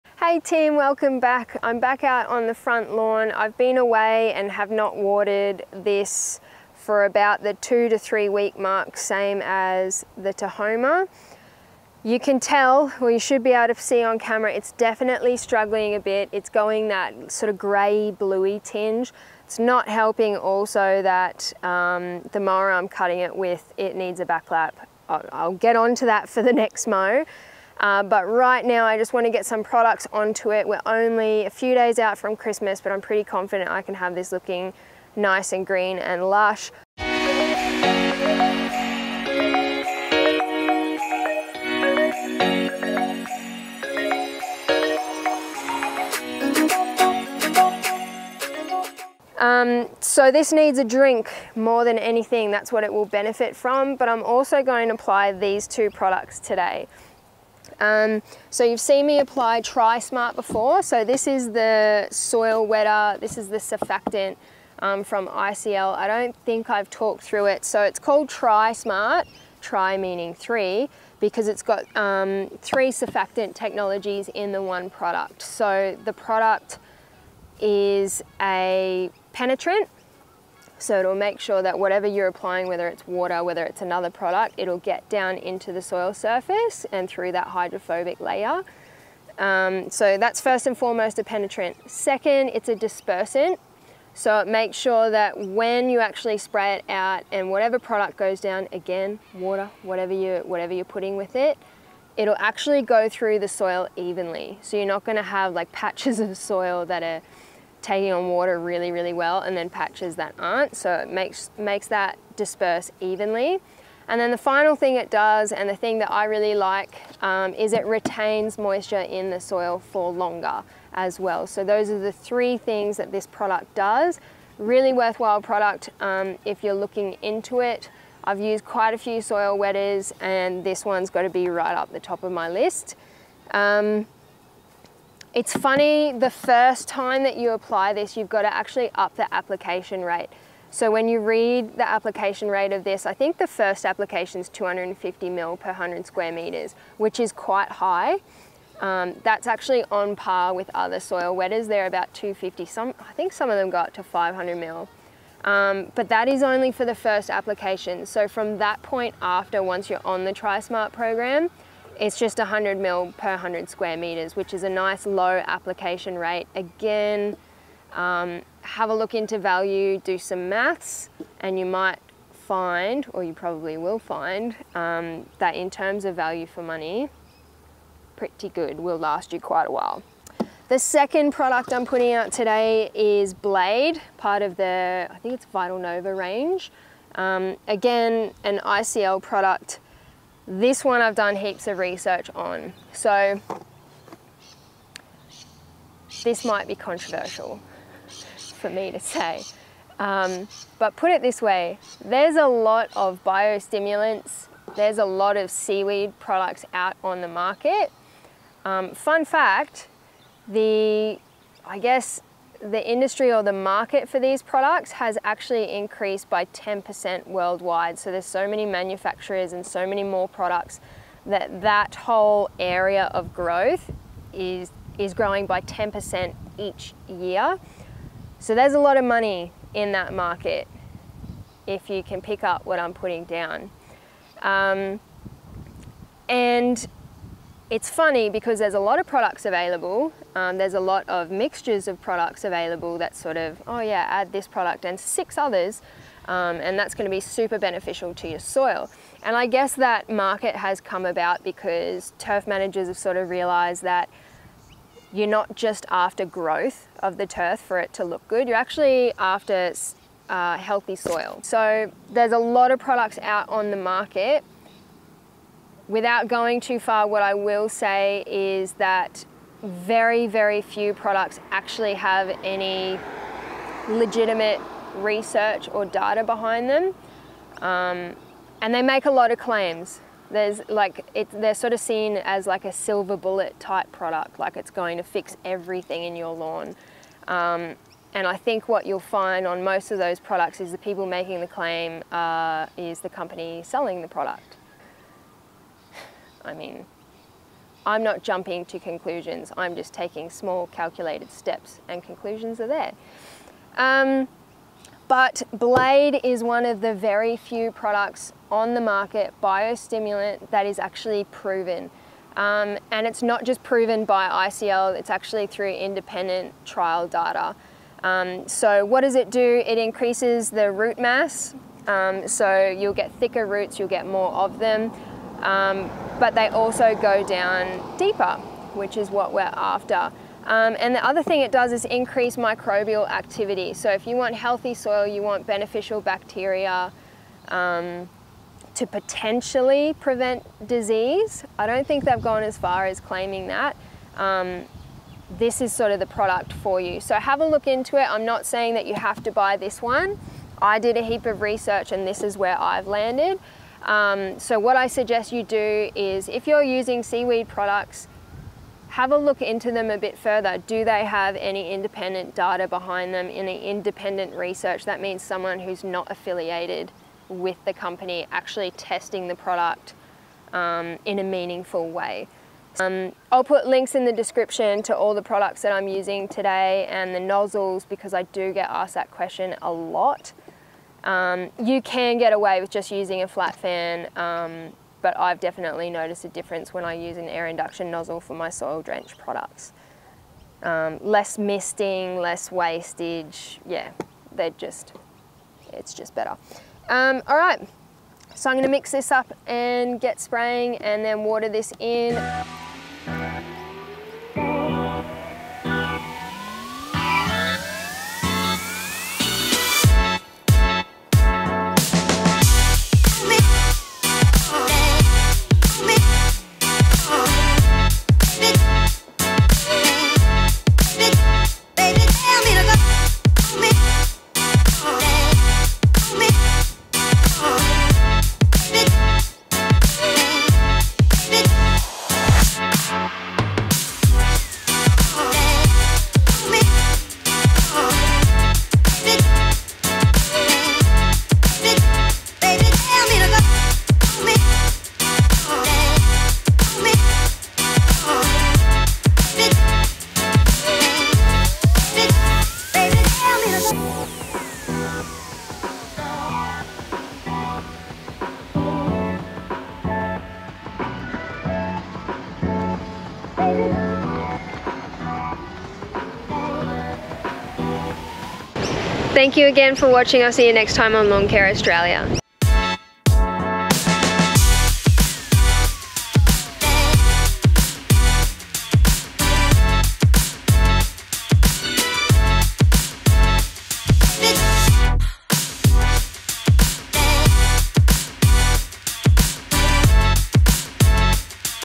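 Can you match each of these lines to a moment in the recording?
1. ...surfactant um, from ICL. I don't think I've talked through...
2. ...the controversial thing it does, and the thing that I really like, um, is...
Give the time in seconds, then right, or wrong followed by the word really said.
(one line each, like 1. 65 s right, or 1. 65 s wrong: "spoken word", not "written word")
1. 63 s right
2. 114 s wrong: "final", not "controversial".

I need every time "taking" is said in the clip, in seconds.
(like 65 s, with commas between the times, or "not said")
107 s, 299 s.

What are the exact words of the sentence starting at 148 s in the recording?
Um, that's actually on par with other soil wetters.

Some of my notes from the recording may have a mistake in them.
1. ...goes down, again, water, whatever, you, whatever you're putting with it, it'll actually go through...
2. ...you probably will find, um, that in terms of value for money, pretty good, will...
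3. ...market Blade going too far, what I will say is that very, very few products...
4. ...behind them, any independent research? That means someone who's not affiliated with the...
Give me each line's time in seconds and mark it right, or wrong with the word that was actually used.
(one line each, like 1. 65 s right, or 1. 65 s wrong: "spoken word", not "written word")
1. 98 s right
2. 173 s right
3. 263 s wrong: "Without", not "Blade"
4. 362 s right.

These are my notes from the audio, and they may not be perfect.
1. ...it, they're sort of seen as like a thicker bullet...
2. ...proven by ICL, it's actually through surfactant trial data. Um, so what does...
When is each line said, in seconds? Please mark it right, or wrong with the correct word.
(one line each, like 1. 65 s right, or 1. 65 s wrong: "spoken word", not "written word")
1. 281 s wrong: "silver", not "thicker"
2. 313 s wrong: "independent", not "surfactant".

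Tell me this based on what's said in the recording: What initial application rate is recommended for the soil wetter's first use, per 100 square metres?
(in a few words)
250 ml.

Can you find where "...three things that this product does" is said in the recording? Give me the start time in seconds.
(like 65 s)
122 s.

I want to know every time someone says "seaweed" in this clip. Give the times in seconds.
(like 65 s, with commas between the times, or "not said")
205 s, 357 s.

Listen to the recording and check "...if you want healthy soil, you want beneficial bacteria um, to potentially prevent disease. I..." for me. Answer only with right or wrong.
right.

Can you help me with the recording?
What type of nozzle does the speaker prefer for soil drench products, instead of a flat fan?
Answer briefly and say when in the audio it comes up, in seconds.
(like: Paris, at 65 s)
Air induction, at 387 s.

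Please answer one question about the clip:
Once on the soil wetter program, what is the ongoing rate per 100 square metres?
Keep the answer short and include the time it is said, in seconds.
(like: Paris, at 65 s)
100 ml, at 162 s.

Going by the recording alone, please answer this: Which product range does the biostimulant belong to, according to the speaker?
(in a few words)
Vitalnova.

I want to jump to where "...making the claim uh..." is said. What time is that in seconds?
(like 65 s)
291 s.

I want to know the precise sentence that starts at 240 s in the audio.
Um, there's a lot of mixtures of products available that sort of, oh yeah, add this product and six others.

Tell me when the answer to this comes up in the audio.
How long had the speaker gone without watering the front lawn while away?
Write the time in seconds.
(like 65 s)
7 s.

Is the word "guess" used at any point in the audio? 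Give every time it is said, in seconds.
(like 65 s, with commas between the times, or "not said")
211 s, 249 s.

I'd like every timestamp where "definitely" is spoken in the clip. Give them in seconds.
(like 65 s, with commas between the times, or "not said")
14 s, 385 s.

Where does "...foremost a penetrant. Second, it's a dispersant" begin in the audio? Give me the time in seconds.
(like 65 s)
90 s.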